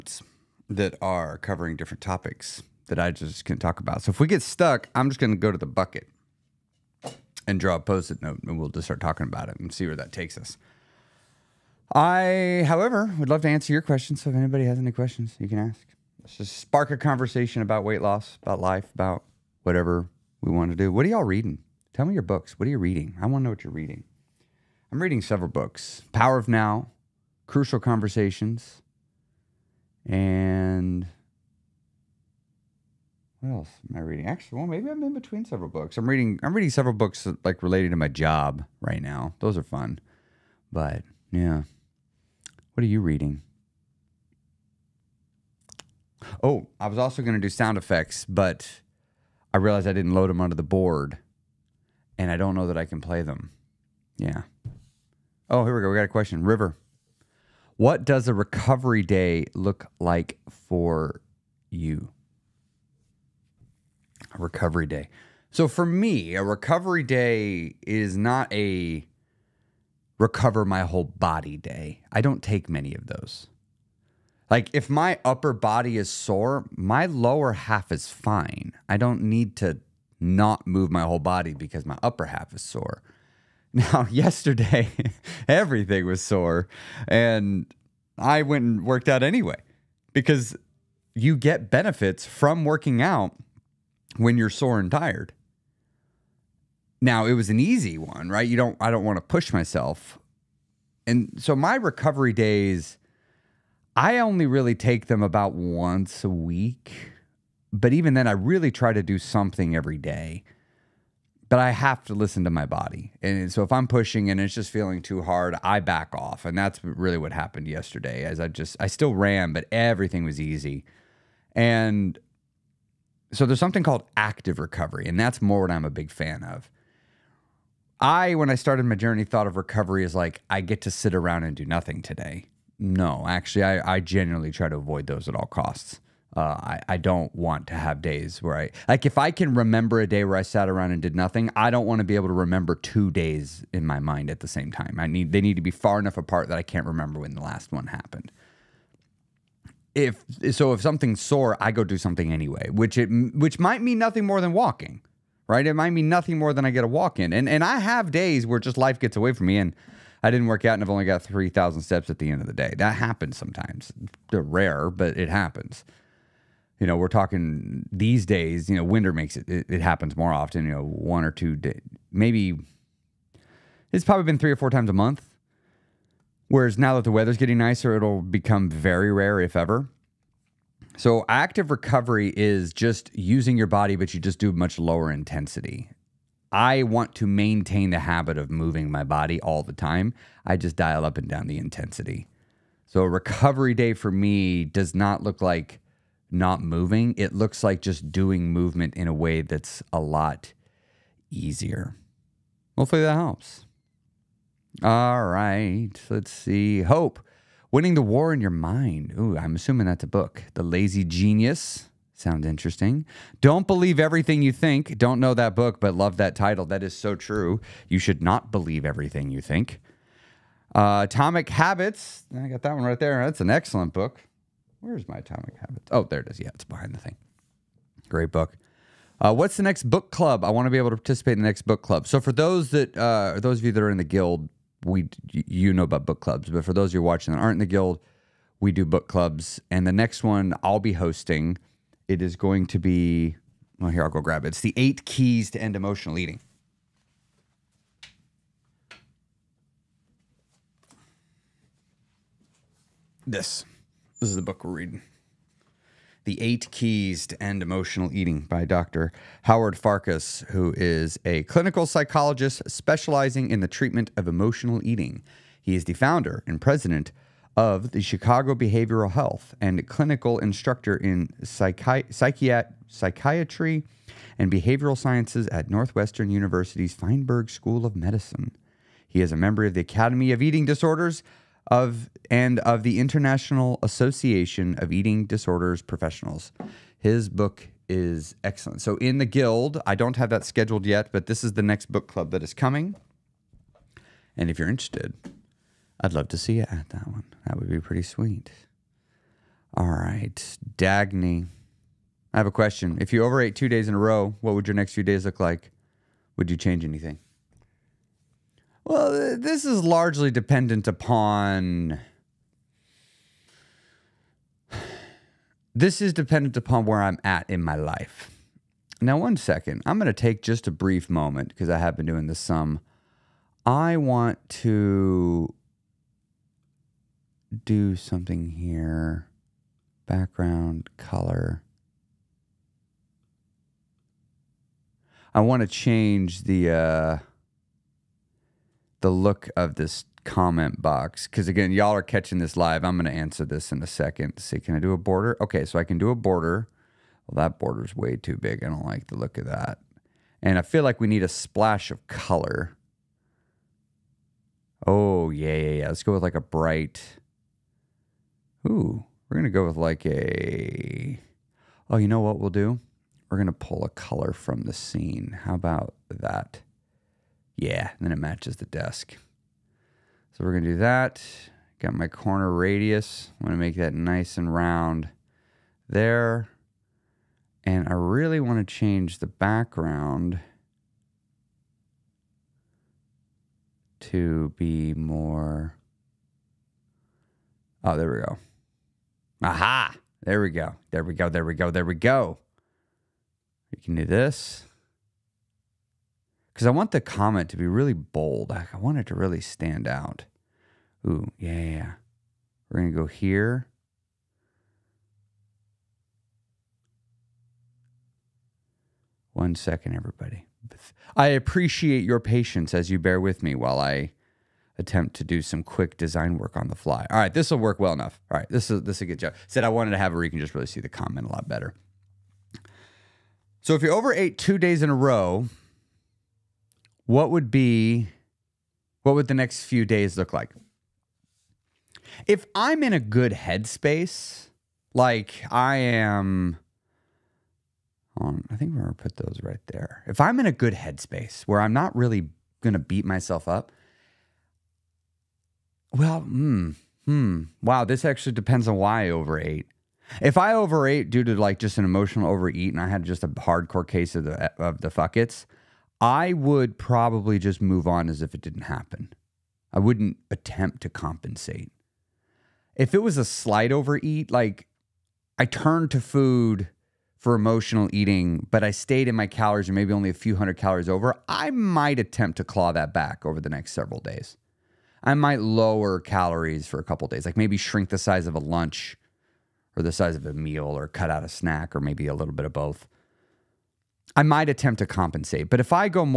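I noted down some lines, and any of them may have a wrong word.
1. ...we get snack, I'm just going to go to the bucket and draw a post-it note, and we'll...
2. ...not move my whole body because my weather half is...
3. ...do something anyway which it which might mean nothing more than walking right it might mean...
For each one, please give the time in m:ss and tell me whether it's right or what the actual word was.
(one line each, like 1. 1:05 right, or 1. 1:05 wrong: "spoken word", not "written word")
1. 0:04 wrong: "stuck", not "snack"
2. 1:20 wrong: "upper", not "weather"
3. 2:31 right.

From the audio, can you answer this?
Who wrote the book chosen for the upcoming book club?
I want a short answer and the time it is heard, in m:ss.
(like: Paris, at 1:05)
Dr. Howard Farkas, at 4:18.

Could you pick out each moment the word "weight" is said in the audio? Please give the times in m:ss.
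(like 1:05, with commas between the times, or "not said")
0:17.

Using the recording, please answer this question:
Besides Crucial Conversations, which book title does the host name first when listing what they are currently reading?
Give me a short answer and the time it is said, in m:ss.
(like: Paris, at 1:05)
Power of Now, at 0:26.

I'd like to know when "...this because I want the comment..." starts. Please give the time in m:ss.
6:34.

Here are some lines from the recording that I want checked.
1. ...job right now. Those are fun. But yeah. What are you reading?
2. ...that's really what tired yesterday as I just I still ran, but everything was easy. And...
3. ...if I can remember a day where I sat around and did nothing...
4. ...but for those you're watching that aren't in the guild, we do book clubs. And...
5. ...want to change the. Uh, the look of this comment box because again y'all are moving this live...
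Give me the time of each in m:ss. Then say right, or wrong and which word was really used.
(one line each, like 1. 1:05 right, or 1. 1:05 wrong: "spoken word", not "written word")
1. 0:38 right
2. 1:56 wrong: "happened", not "tired"
3. 2:19 right
4. 3:56 right
5. 5:35 wrong: "catching", not "moving".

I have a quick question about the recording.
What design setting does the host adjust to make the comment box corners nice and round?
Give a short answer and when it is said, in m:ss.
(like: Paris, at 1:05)
corner radius, at 6:12.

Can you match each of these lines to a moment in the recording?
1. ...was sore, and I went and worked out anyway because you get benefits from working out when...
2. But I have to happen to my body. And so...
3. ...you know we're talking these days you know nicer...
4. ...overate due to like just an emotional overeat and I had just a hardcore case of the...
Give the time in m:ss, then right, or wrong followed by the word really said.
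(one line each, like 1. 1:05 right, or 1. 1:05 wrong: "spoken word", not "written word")
1. 1:26 right
2. 1:51 wrong: "listen", not "happen"
3. 2:46 wrong: "winter", not "nicer"
4. 7:30 right.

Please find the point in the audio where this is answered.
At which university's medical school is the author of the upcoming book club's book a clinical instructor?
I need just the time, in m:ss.
4:35.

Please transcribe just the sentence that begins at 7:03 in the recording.
So if you're over eight two days in a row, what would be what would the next few days look like?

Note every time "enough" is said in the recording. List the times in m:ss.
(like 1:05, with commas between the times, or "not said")
2:25, 6:57.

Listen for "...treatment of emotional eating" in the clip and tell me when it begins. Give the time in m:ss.
4:23.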